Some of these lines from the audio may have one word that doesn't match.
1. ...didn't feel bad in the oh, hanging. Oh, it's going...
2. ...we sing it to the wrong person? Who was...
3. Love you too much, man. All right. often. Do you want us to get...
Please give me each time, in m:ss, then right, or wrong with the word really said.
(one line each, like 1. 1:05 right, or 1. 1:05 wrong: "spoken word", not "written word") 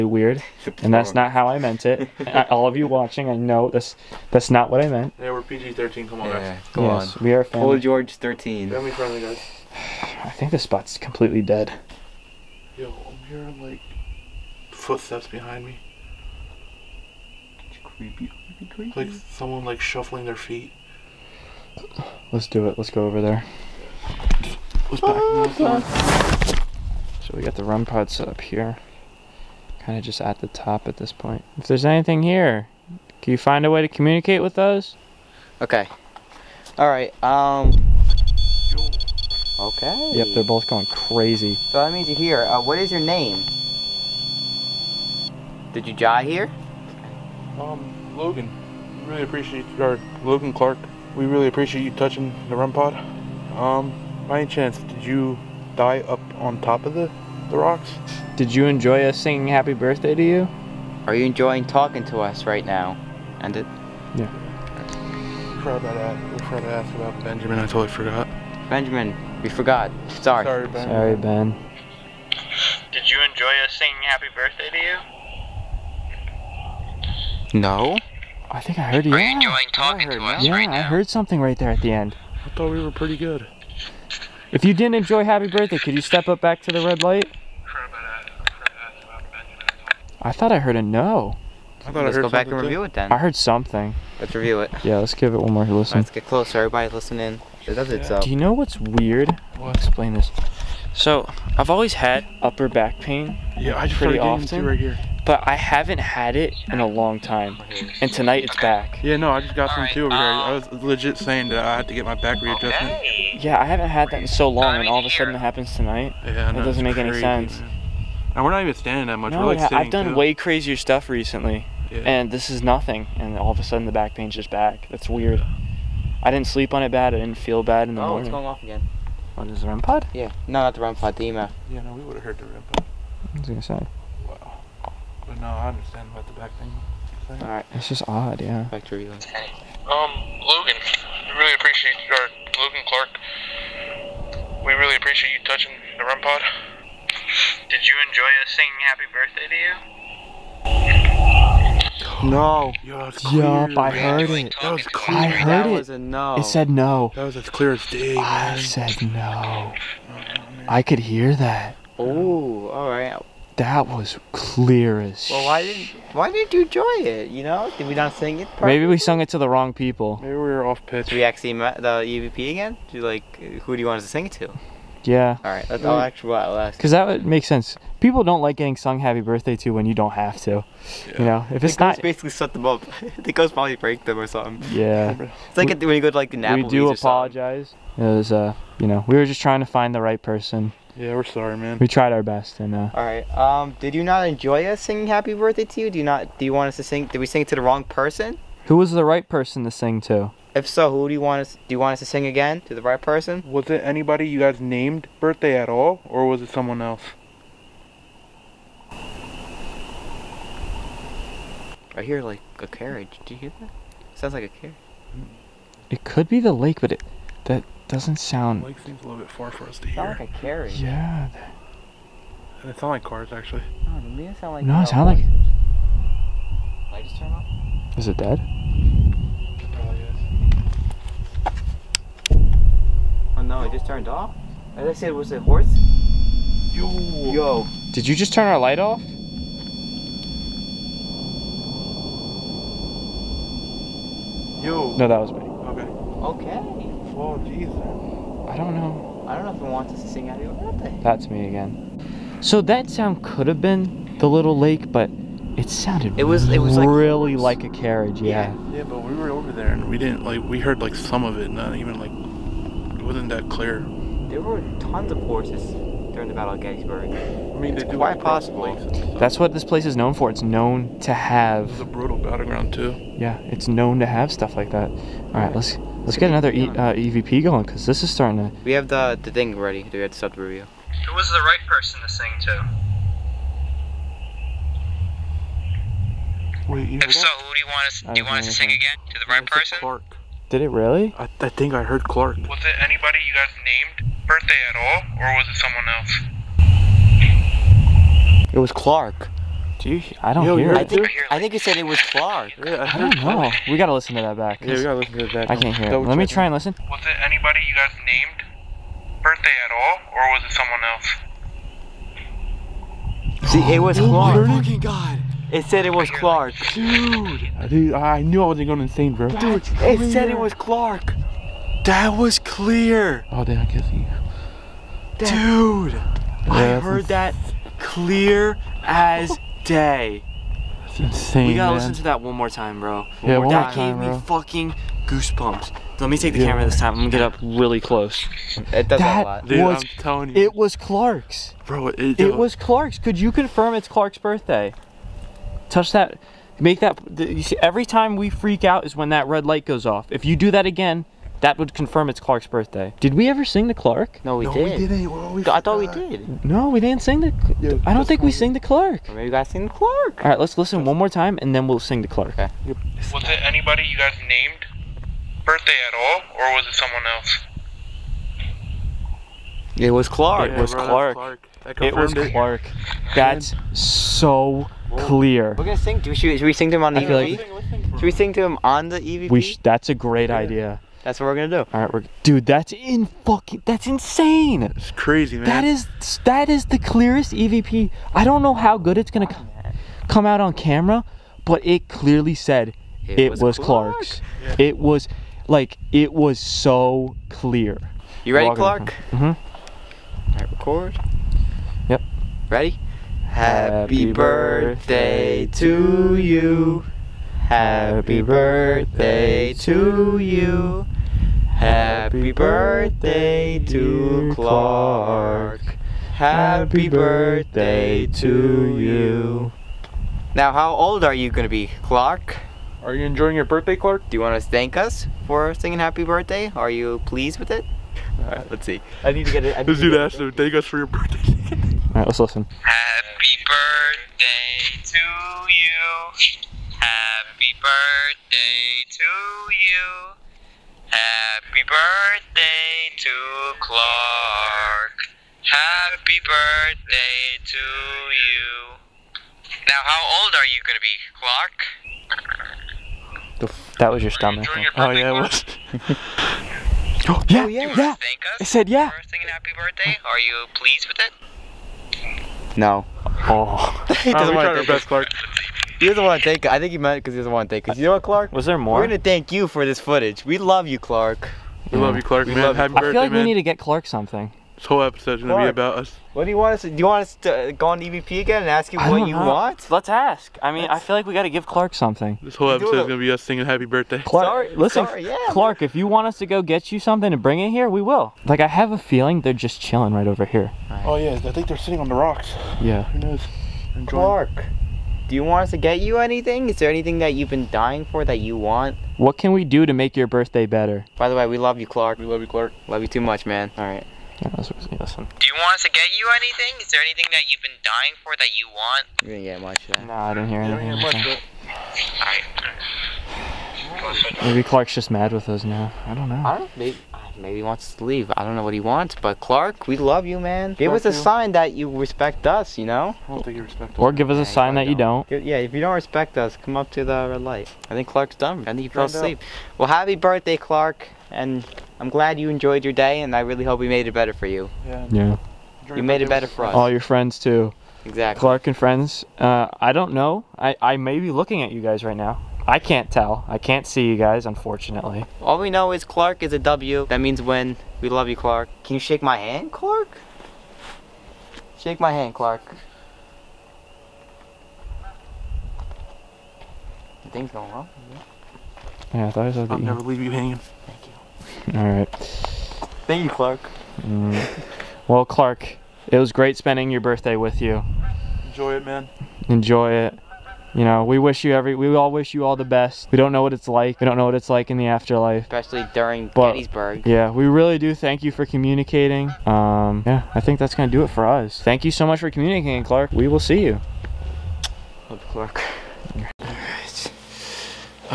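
1. 2:07 wrong: "morning", not "hanging"
2. 3:17 right
3. 8:22 wrong: "listen", not "often".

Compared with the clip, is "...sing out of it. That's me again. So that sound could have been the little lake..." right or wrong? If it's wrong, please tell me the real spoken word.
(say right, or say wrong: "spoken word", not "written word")
right.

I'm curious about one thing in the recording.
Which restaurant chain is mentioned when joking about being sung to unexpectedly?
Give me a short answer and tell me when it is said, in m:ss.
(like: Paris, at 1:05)
Applebee's, at 3:06.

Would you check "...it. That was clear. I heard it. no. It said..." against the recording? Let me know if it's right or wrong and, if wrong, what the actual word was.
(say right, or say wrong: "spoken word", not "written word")
right.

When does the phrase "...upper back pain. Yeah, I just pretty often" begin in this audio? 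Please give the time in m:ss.
1:42.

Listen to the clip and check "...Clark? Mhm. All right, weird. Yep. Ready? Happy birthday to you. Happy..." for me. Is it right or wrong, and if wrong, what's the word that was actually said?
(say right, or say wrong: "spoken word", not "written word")
wrong: "record", not "weird".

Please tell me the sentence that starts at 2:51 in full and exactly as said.
Did we actually met the EVP again?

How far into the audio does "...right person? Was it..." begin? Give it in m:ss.
3:22.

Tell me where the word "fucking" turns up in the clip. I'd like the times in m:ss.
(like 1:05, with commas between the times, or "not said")
5:34, 6:23.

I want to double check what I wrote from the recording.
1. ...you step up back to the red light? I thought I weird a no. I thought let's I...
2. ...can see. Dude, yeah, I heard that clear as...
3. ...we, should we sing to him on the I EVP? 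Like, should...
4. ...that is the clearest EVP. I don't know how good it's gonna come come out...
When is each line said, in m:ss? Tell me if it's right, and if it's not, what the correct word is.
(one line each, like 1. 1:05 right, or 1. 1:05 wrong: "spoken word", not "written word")
1. 1:25 wrong: "heard", not "weird"
2. 5:23 right
3. 6:16 right
4. 6:26 right.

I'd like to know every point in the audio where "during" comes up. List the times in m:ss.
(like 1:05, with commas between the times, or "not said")
4:26, 9:35.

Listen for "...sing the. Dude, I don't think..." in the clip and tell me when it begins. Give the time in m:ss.
5:57.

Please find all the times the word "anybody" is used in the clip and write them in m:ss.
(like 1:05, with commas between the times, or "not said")
3:23, 4:52, 5:07, 6:03.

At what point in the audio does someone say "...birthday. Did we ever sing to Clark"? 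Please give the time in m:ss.
5:52.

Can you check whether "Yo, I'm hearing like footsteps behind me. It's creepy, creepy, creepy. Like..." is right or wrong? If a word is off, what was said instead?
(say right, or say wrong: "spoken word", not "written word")
right.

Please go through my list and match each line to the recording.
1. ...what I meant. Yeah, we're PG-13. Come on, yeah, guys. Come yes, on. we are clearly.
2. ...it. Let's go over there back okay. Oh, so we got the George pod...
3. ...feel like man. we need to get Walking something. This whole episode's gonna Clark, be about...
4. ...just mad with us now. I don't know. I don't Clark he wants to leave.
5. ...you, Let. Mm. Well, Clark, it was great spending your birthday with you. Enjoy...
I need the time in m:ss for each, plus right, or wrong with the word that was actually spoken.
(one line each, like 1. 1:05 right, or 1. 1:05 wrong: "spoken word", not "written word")
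1. 0:04 wrong: "family", not "clearly"
2. 0:22 wrong: "REM", not "George"
3. 7:52 wrong: "Clark", not "Walking"
4. 8:34 wrong: "Maybe", not "Clark"
5. 9:23 wrong: "Clark", not "Let".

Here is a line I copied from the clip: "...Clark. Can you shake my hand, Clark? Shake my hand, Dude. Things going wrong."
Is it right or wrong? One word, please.
wrong.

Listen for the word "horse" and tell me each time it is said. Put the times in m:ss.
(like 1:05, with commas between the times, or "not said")
3:55, 4:25.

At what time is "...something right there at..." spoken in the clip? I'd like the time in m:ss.
1:21.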